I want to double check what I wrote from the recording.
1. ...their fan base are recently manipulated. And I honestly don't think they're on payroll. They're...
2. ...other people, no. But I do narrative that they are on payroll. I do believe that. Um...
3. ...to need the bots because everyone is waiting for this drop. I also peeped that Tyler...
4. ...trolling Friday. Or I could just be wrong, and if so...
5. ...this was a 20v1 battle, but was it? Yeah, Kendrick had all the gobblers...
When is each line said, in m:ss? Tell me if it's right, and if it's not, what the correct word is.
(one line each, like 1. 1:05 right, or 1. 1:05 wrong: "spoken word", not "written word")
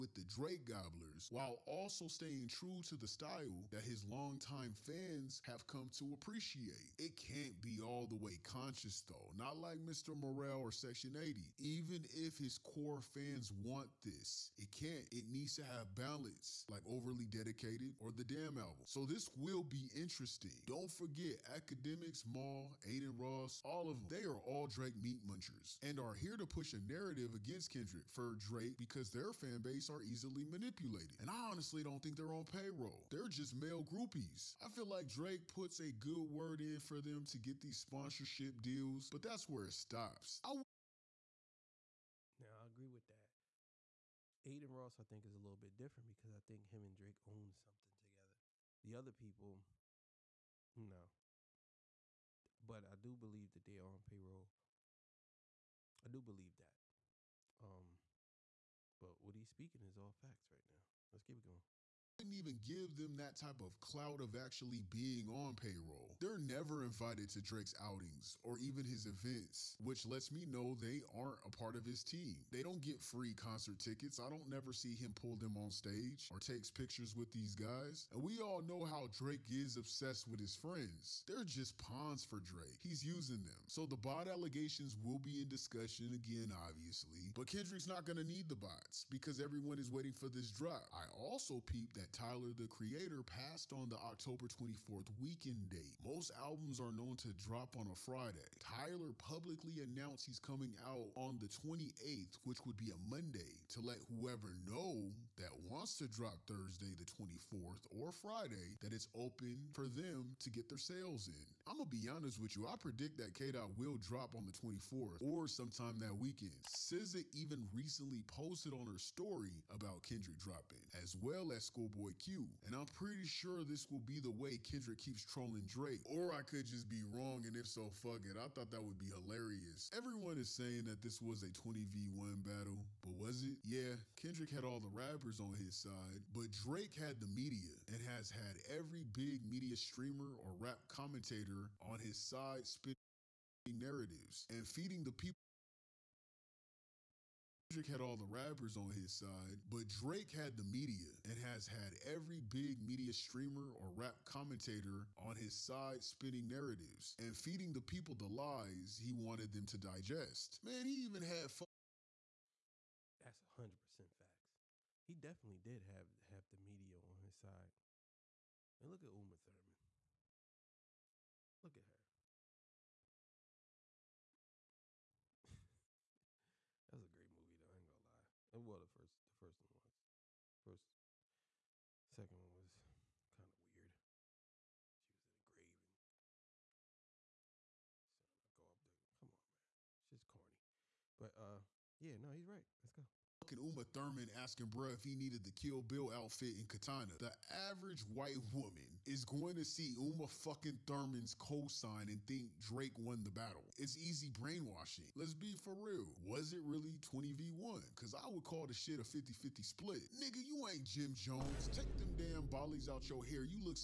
1. 0:29 wrong: "easily", not "recently"
2. 0:48 wrong: "believe", not "narrative"
3. 1:28 right
4. 2:05 wrong: "Drake", not "Friday"
5. 2:11 wrong: "rappers", not "gobblers".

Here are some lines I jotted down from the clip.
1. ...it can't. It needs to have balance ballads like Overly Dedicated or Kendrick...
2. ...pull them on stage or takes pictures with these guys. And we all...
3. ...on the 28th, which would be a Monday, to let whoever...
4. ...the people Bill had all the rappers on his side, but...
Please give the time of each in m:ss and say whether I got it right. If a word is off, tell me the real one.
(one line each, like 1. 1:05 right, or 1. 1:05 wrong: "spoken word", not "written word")
1. 0:14 wrong: "The", not "Kendrick"
2. 1:15 right
3. 1:41 right
4. 2:25 wrong: "Kendrick", not "Bill".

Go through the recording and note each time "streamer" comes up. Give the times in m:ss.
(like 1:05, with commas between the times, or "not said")
2:19, 2:33.